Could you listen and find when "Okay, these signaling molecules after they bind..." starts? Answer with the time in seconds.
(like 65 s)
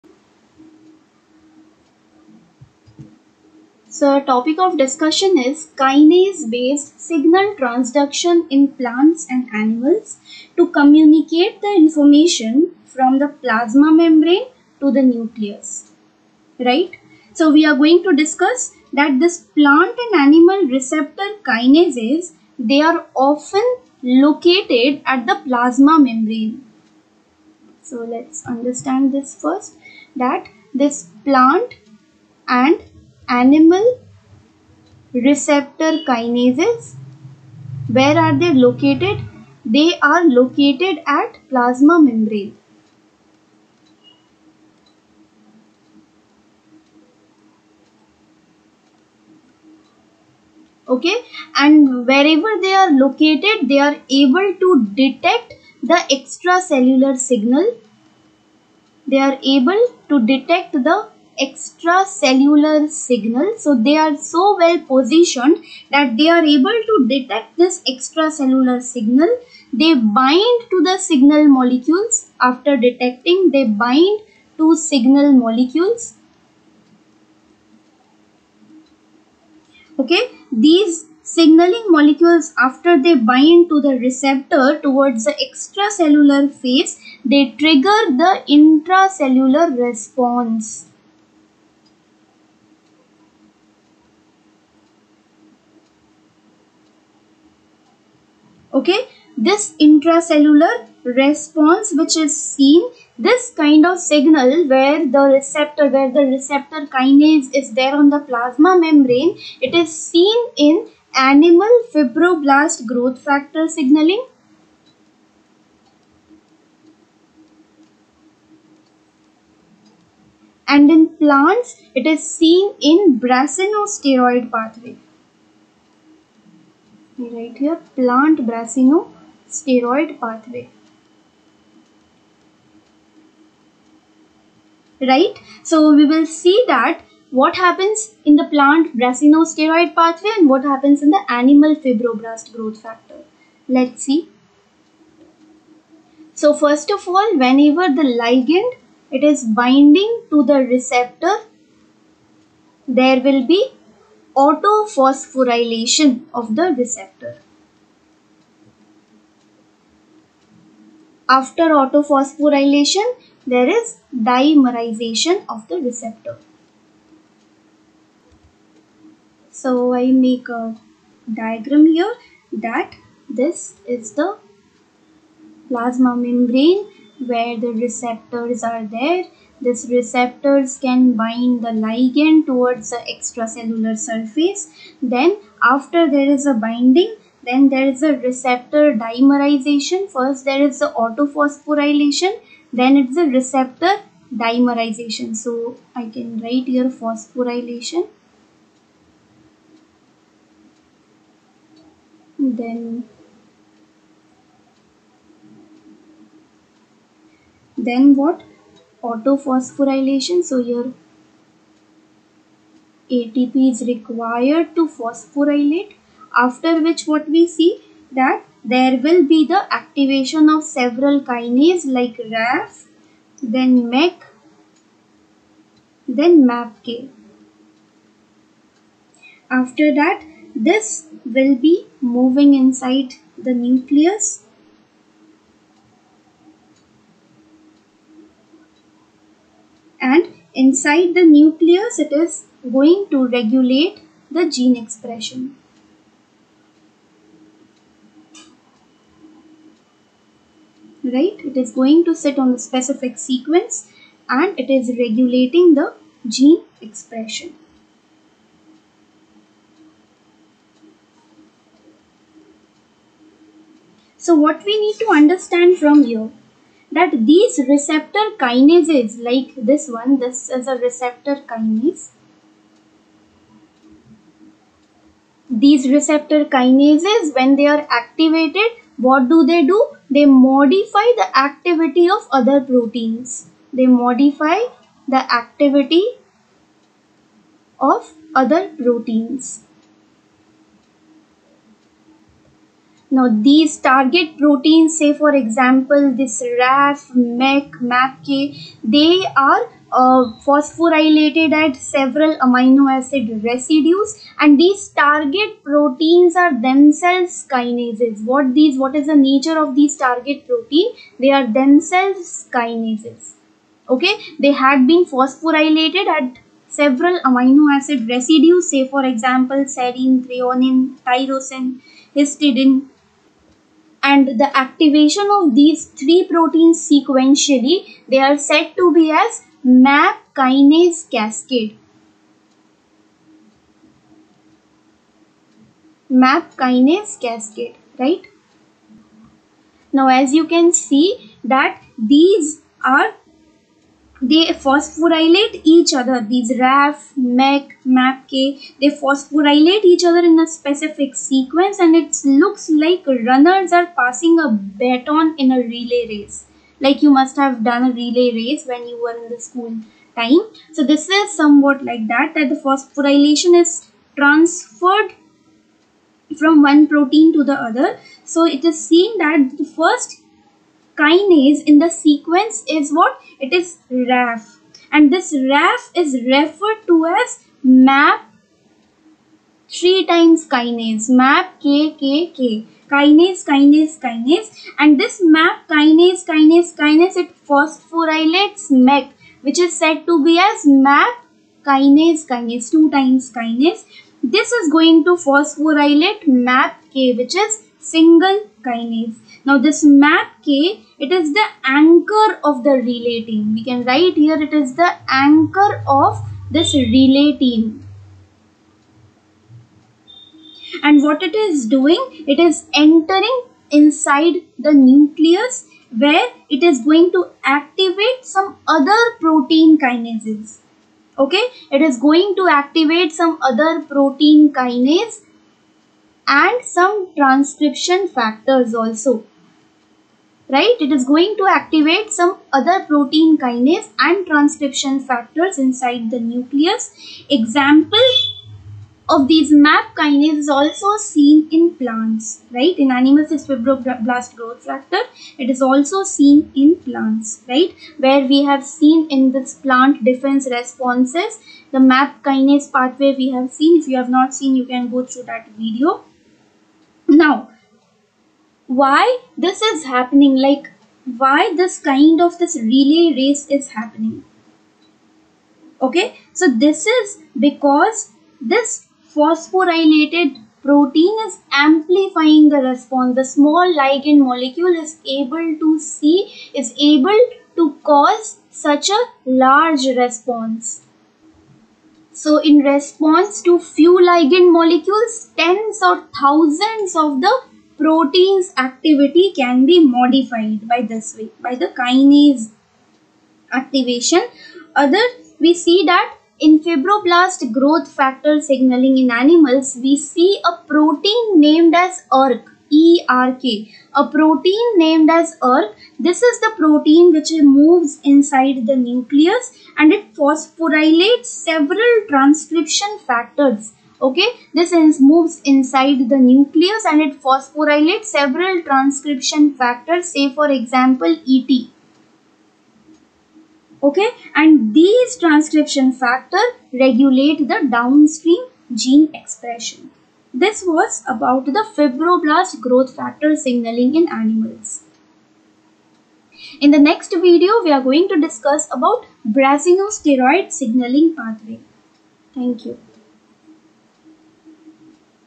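79 s.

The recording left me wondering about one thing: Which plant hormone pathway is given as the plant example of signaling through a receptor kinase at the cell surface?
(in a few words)
Brassinosteroid pathway.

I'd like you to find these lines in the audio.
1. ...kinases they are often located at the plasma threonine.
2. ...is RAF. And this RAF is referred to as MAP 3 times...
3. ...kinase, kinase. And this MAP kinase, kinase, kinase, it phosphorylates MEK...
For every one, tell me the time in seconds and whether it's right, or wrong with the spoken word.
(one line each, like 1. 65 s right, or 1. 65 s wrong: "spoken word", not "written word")
1. 21 s wrong: "membrane", not "threonine"
2. 373 s right
3. 383 s right.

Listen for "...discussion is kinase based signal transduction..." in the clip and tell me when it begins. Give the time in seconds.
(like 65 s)
4 s.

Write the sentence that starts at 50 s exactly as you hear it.
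okay and wherever they are located they are able to detect the extracellular signal they are able to detect the extracellular signal.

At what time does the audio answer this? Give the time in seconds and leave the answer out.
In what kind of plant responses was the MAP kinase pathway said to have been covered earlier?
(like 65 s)
449 s.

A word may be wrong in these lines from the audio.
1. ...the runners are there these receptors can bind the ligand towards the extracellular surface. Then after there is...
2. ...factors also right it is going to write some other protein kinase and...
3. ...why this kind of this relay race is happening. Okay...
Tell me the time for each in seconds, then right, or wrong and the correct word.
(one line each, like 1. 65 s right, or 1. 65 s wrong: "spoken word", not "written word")
1. 177 s wrong: "receptors", not "runners"
2. 428 s wrong: "activate", not "write"
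3. 461 s right.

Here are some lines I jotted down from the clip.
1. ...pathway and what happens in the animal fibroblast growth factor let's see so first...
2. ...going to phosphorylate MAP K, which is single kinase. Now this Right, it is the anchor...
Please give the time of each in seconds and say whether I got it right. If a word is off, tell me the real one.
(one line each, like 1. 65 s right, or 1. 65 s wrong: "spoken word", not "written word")
1. 139 s right
2. 394 s wrong: "MAPK", not "Right".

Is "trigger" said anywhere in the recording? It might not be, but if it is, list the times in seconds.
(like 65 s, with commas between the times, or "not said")
87 s.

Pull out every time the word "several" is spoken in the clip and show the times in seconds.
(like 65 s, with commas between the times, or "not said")
220 s, 301 s, 316 s, 511 s, 518 s.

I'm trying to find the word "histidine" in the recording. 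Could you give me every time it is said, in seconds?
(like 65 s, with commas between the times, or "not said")
322 s.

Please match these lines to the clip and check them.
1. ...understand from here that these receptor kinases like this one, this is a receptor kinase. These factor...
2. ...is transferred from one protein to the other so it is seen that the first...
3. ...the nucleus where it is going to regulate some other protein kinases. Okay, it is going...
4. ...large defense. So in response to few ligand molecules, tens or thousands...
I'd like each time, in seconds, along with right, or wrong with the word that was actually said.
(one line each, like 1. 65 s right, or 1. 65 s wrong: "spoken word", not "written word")
1. 265 s wrong: "receptor", not "factor"
2. 363 s right
3. 414 s wrong: "activate", not "regulate"
4. 479 s wrong: "response", not "defense".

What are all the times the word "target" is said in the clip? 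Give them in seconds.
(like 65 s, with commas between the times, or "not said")
293 s, 304 s, 309 s.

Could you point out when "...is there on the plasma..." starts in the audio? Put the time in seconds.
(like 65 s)
107 s.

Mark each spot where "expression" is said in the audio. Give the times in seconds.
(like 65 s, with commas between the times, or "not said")
244 s, 256 s, 529 s.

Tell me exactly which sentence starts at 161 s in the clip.
After autophosphorylation, there is dimerization of the receptor.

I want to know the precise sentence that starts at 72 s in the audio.
After detecting, they bind to signal molecules.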